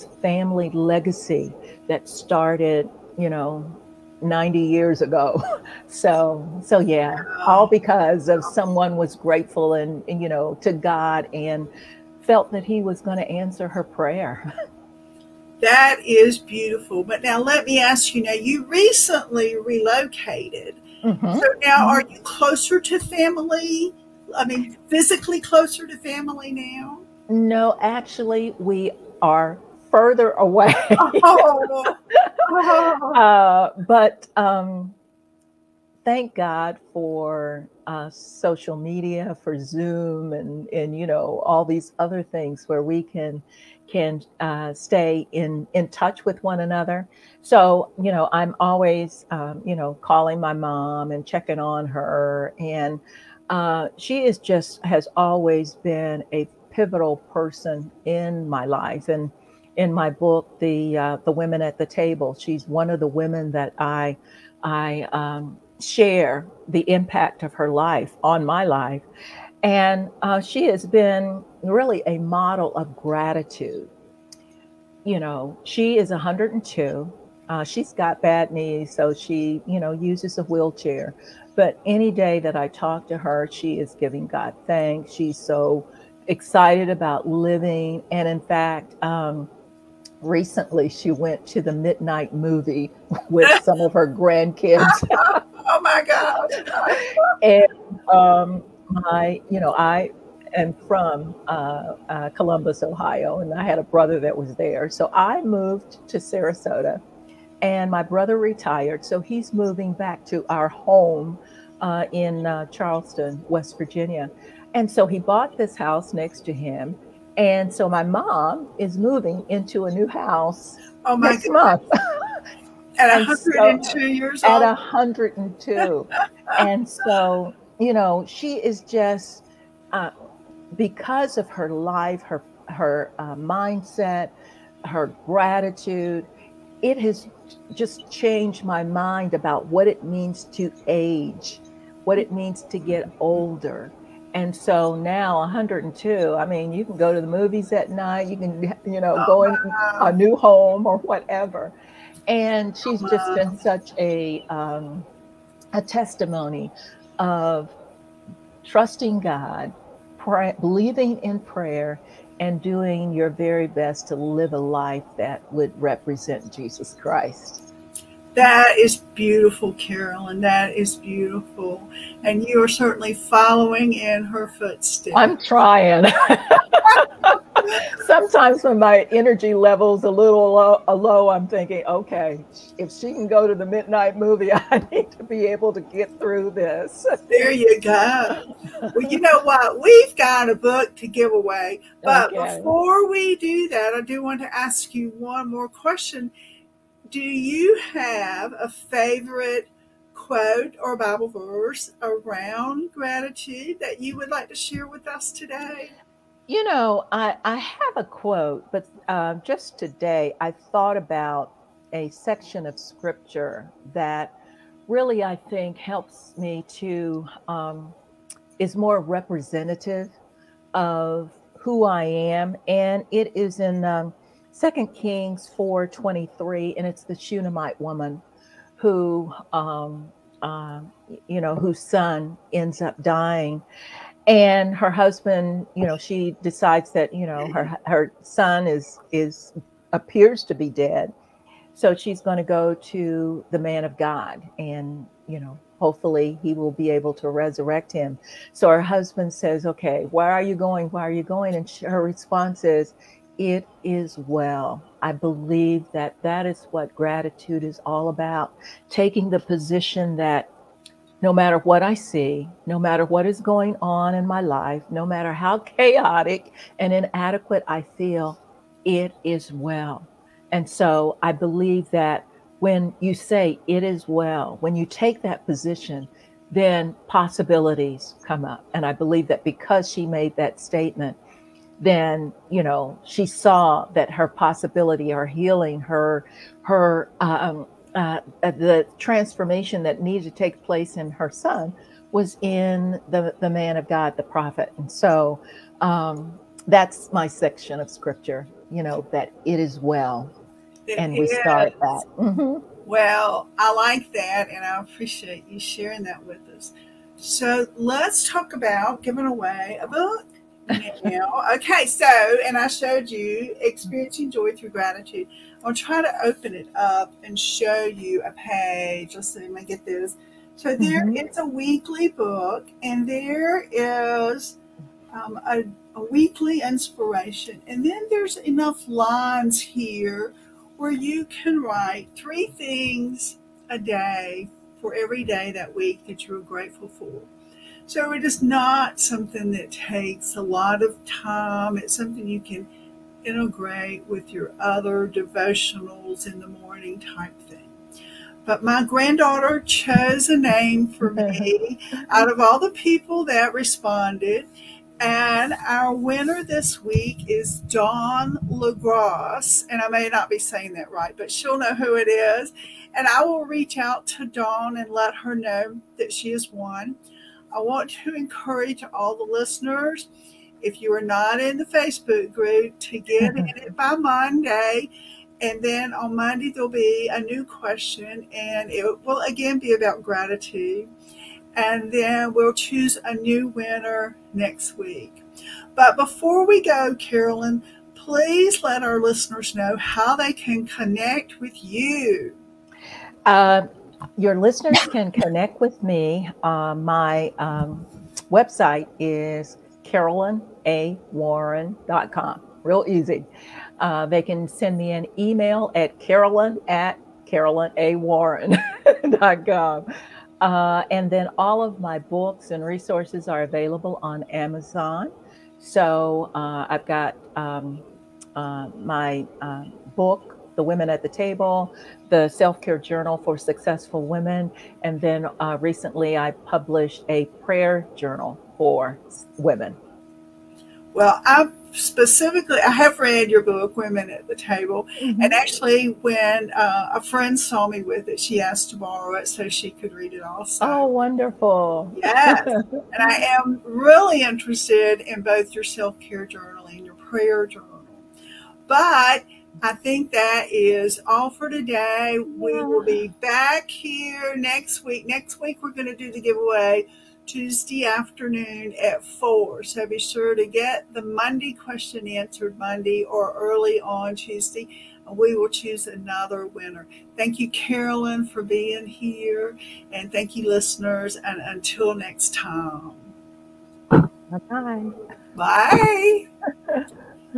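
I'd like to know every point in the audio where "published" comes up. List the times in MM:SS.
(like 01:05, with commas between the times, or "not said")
07:06.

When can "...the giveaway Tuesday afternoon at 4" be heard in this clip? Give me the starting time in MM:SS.
07:36.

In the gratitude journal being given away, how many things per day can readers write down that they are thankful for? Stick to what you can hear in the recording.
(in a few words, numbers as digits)
3.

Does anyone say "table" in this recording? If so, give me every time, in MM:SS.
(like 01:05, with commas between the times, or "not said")
01:01, 07:01, 07:14.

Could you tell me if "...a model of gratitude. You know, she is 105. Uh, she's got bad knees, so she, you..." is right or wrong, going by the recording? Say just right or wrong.
wrong.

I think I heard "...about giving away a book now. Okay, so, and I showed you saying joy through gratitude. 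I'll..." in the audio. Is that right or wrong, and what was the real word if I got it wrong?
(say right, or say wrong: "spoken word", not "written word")
wrong: "experiencing", not "saying".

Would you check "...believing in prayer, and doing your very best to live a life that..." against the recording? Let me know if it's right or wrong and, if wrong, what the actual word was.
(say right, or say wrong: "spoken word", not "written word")
right.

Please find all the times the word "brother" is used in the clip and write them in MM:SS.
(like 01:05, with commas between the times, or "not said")
01:43, 01:48.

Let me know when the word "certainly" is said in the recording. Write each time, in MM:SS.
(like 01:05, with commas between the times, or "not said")
02:52.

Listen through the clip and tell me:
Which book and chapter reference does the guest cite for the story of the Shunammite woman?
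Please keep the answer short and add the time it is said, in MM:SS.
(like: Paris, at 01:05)
Second Kings 4:23, at 03:44.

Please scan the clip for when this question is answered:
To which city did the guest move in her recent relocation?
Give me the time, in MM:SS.
01:46.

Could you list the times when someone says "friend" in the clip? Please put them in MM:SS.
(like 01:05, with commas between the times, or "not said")
07:17.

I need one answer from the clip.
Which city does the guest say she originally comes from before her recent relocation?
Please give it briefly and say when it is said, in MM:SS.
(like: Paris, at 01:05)
Columbus, Ohio, at 01:42.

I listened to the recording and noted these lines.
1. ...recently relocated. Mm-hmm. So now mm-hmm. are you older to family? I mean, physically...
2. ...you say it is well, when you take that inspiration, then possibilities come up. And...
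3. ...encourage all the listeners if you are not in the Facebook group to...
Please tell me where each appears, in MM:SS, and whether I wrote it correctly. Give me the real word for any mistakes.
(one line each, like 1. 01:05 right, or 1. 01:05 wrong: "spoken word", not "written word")
1. 00:18 wrong: "closer", not "older"
2. 04:32 wrong: "position", not "inspiration"
3. 06:08 right.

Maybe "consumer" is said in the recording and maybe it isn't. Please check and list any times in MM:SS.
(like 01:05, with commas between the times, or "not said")
not said.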